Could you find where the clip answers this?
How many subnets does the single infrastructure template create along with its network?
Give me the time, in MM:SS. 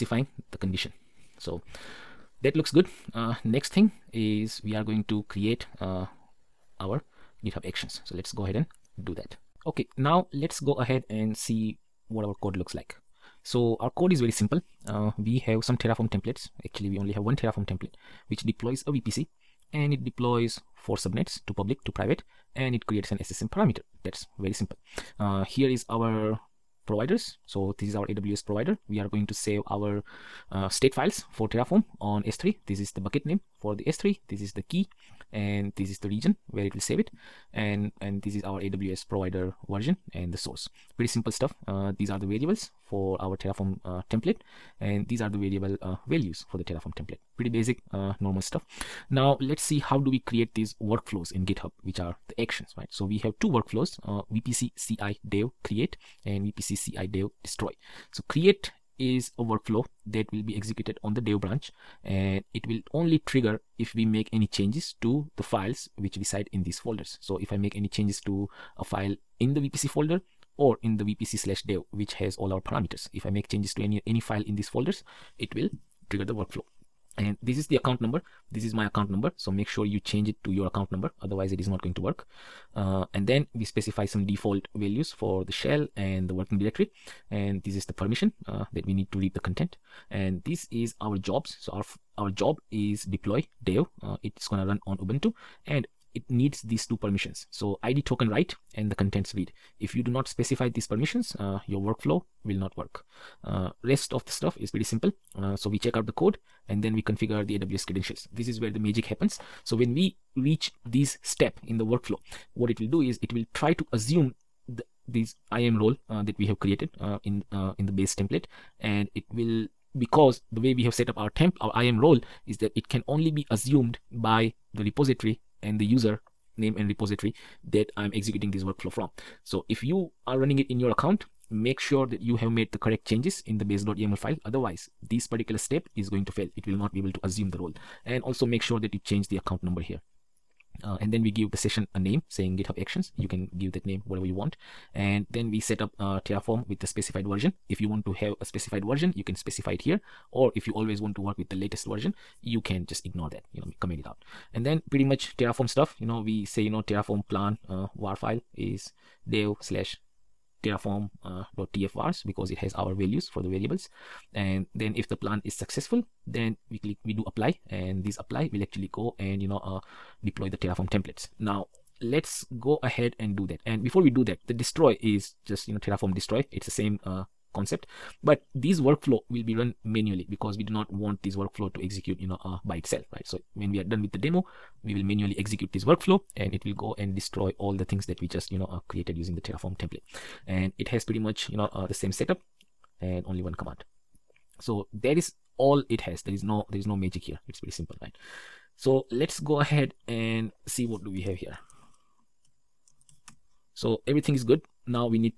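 00:20.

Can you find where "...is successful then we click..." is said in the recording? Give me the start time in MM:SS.
02:45.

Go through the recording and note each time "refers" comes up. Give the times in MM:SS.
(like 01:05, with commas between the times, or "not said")
not said.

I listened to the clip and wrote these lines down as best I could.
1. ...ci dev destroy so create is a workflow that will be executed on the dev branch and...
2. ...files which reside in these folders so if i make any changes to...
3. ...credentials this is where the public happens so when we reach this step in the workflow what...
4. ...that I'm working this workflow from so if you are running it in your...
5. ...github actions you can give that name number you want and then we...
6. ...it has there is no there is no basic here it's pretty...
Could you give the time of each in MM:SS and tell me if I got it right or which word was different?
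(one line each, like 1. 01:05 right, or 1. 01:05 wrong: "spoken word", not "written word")
1. 00:56 right
2. 01:05 right
3. 01:47 wrong: "magic", not "public"
4. 02:07 wrong: "executing", not "working"
5. 02:22 wrong: "whatever", not "number"
6. 03:15 wrong: "magic", not "basic".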